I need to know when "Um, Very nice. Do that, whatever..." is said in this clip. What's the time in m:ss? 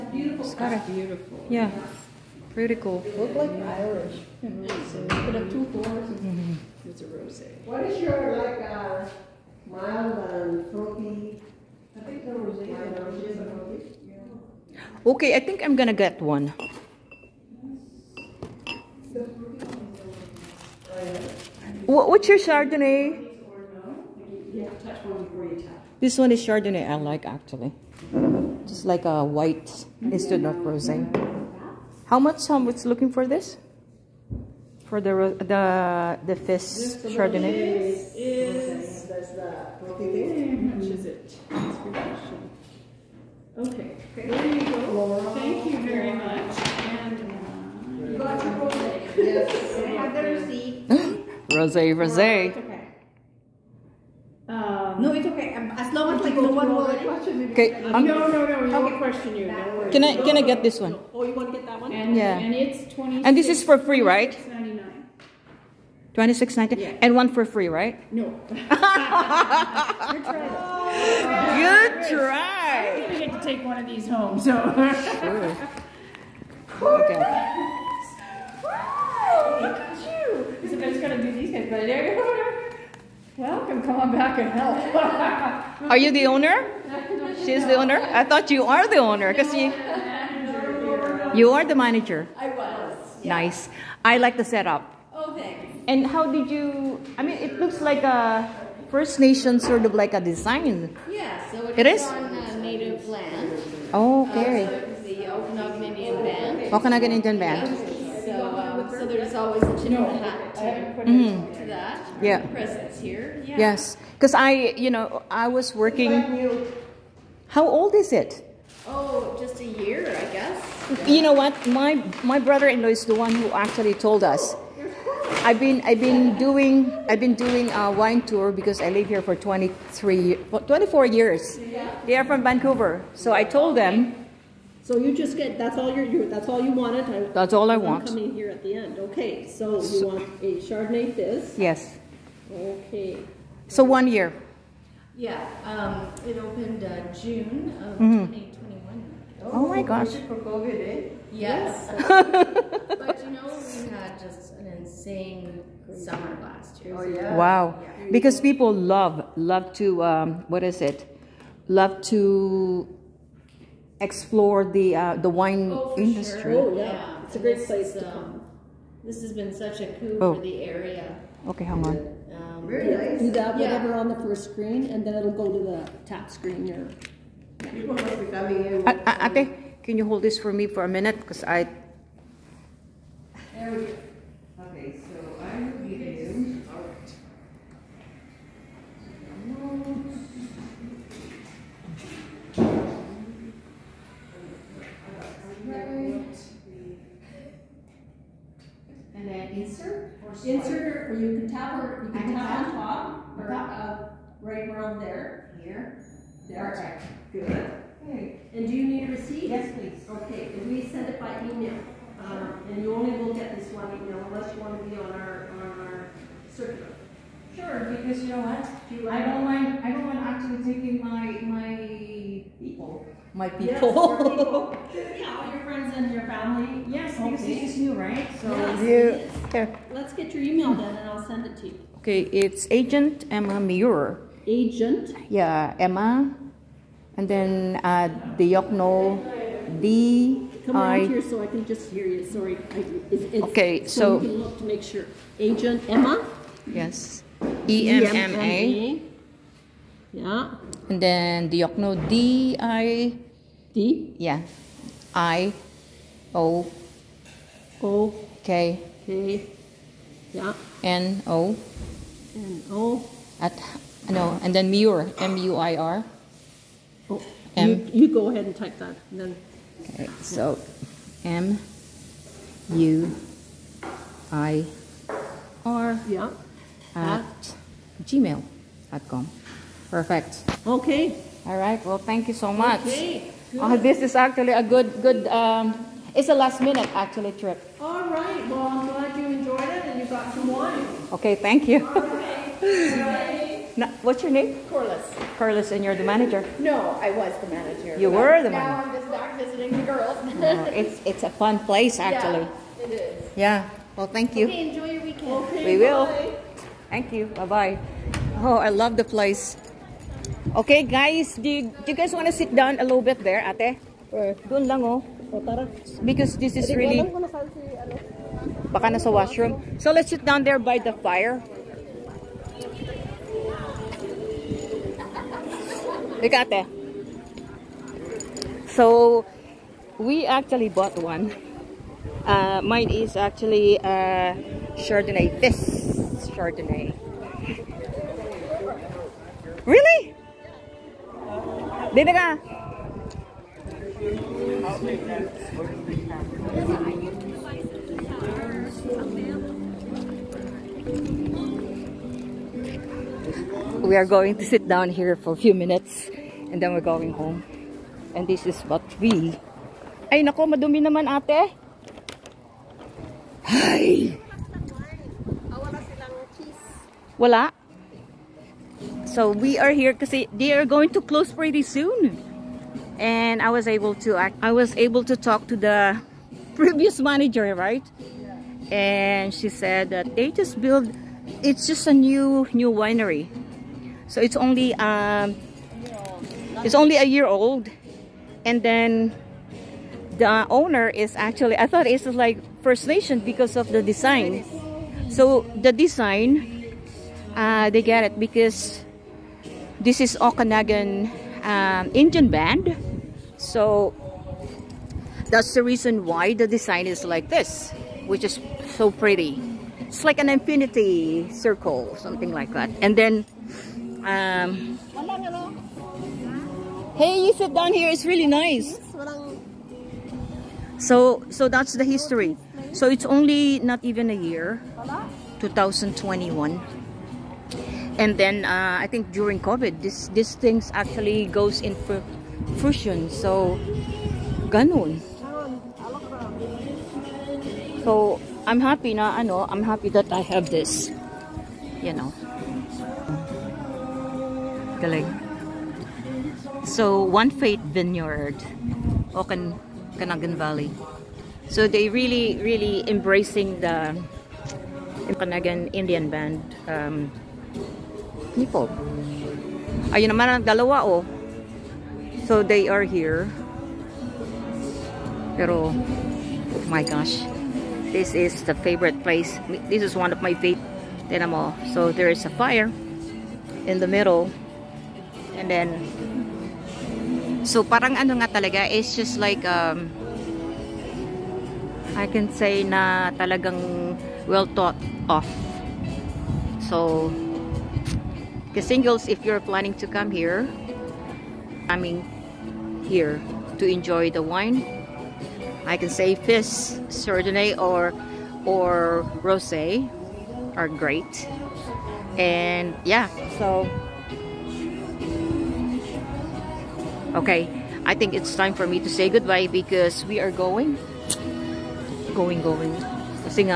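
2:52.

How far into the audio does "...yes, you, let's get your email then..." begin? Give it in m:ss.
3:48.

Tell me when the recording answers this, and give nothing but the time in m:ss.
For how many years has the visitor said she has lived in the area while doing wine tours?
2:10.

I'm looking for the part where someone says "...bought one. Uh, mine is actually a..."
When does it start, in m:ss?
5:30.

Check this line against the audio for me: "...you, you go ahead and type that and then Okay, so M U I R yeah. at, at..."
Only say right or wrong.
right.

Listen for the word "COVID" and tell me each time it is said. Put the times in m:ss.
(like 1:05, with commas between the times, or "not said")
2:30, 7:09.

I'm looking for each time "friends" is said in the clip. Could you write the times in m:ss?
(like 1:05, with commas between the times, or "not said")
3:45.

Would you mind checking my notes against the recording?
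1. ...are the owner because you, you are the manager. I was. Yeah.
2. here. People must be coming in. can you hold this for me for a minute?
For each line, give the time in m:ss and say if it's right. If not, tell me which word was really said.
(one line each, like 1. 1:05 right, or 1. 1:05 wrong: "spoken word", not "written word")
1. 1:28 right
2. 2:56 right.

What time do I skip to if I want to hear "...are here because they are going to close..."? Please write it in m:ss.
6:09.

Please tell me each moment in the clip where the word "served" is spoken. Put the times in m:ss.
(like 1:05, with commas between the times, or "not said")
not said.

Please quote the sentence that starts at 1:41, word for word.
Yeah, so it, it is, on uh, native land.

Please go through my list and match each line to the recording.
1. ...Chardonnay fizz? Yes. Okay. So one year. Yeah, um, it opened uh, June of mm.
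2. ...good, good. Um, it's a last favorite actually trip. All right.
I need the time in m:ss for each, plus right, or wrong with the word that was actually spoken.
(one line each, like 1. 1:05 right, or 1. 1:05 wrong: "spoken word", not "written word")
1. 2:20 right
2. 4:44 wrong: "minute", not "favorite".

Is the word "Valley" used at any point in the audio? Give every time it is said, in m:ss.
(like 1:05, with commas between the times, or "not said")
7:30.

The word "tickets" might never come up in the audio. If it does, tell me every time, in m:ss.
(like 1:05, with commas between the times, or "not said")
not said.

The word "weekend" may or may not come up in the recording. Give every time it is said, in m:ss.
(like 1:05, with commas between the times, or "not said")
5:05.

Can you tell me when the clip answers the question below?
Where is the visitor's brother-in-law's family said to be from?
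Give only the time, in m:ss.
2:12.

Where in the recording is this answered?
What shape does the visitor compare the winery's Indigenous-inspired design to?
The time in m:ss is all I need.
6:50.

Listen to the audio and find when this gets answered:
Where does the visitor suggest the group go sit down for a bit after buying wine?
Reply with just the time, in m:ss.
5:20.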